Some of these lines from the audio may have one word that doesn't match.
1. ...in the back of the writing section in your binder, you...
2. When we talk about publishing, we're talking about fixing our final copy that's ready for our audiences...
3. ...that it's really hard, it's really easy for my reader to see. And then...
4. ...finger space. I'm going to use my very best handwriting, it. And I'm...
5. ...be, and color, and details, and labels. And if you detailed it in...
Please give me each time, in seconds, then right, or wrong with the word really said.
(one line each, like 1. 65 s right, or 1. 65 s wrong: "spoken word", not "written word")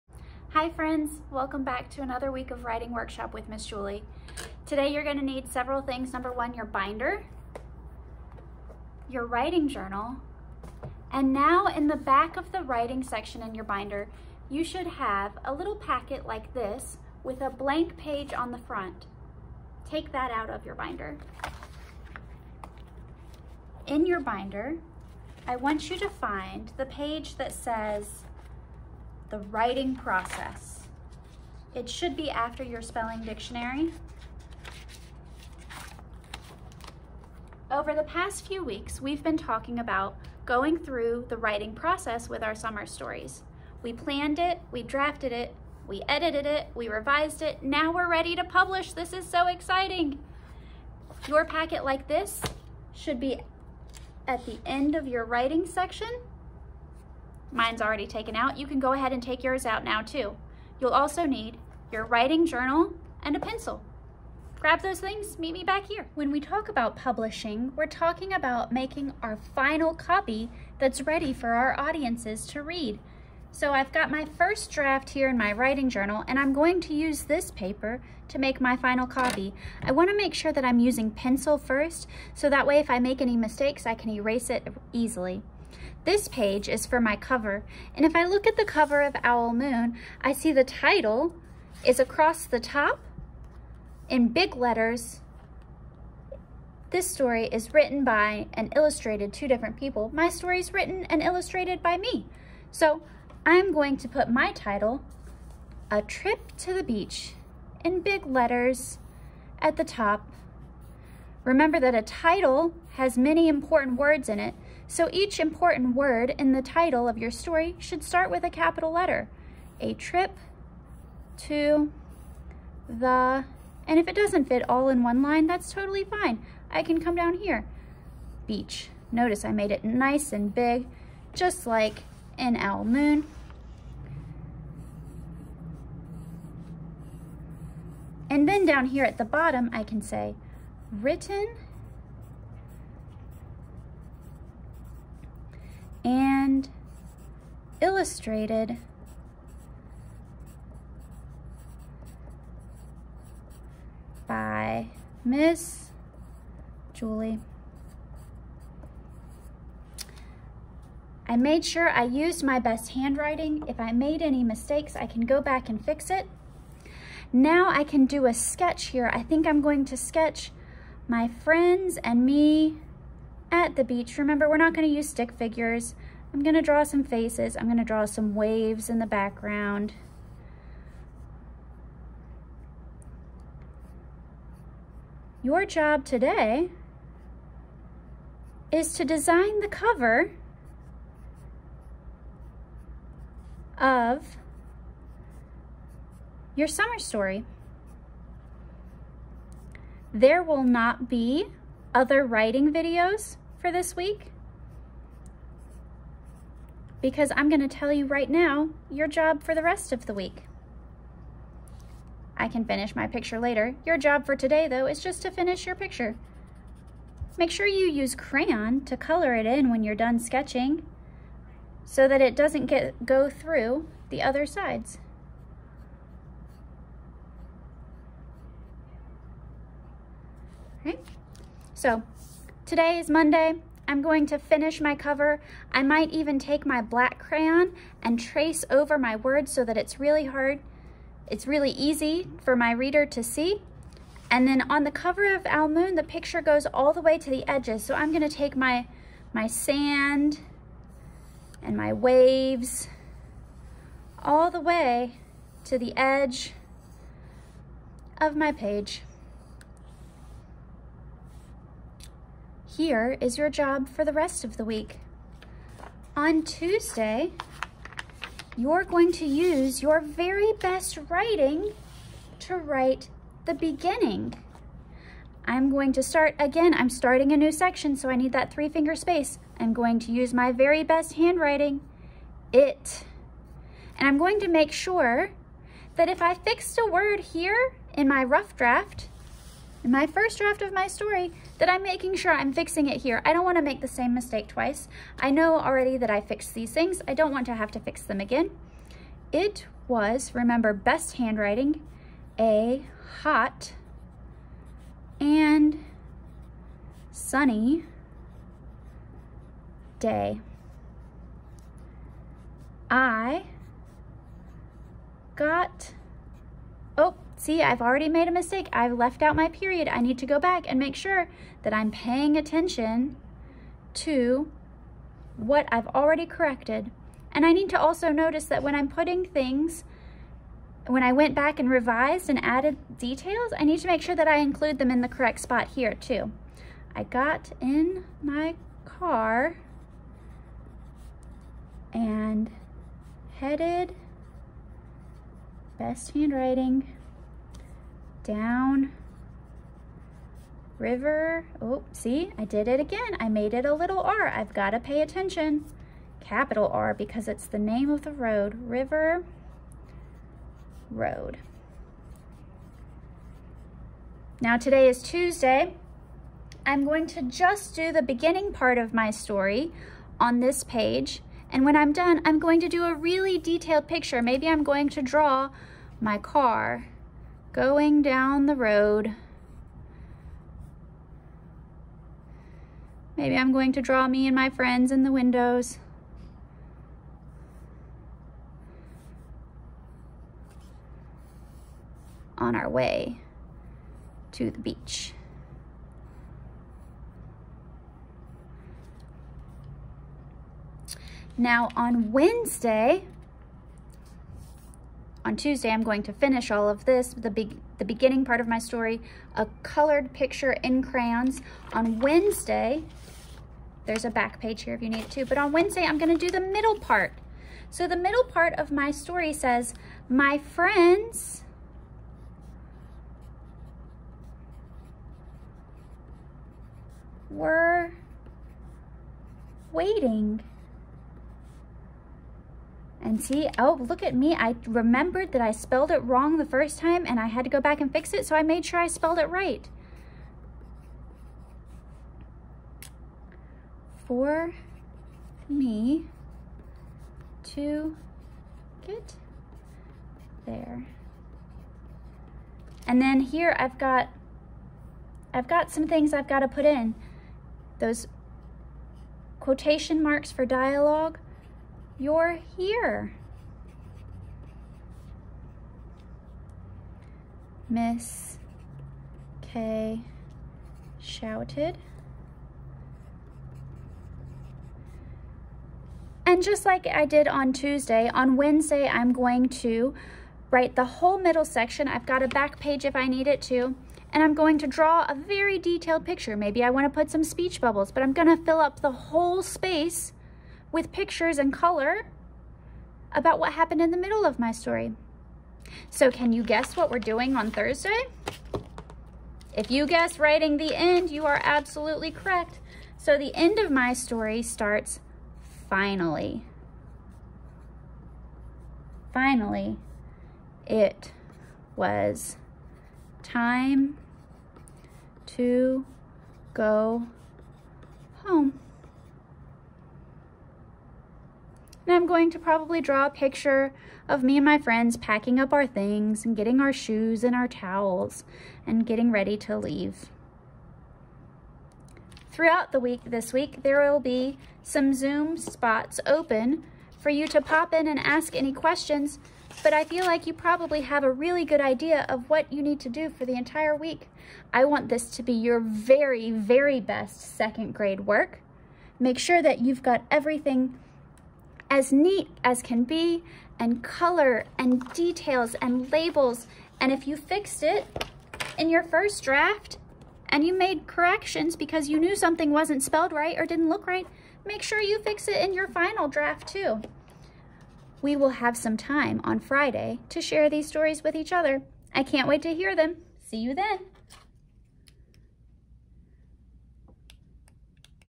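1. 11 s right
2. 66 s wrong: "making", not "fixing"
3. 239 s right
4. 278 s right
5. 552 s wrong: "fixed", not "detailed".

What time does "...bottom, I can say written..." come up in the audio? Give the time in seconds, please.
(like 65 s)
139 s.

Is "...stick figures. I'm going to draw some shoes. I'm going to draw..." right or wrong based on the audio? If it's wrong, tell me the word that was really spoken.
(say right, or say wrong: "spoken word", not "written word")
wrong: "faces", not "shoes".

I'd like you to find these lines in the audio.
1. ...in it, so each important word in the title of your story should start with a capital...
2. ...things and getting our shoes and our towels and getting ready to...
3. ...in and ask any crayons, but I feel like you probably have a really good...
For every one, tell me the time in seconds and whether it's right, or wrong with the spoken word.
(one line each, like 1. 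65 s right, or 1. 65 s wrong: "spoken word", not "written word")
1. 114 s right
2. 525 s right
3. 537 s wrong: "questions", not "crayons".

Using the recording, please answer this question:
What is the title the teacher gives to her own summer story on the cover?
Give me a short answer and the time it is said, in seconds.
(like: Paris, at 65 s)
A Trip to the Beach, at 105 s.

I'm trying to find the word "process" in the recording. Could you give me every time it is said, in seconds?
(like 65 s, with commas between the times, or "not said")
29 s, 41 s.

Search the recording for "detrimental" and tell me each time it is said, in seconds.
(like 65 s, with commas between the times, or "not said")
not said.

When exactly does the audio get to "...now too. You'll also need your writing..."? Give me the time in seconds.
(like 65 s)
59 s.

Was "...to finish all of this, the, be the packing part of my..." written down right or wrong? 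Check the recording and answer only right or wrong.
wrong.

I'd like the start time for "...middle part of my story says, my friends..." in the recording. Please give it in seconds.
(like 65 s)
417 s.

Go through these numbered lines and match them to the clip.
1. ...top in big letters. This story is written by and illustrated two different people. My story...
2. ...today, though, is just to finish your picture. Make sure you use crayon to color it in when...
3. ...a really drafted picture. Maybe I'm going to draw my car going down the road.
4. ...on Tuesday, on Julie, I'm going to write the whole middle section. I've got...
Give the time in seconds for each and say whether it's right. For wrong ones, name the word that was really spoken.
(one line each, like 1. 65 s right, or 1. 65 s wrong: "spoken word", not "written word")
1. 92 s right
2. 214 s right
3. 372 s wrong: "detailed", not "drafted"
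4. 477 s wrong: "Wednesday", not "Julie".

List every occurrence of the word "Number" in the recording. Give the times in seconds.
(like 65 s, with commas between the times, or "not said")
6 s.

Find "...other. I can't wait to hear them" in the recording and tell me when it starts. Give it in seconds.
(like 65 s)
571 s.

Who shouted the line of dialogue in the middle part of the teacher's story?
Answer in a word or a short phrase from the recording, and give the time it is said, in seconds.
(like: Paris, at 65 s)
Miss K, at 467 s.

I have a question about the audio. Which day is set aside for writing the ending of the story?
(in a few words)
Thursday.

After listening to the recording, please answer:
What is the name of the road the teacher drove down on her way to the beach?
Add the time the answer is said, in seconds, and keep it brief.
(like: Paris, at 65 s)
River Road, at 358 s.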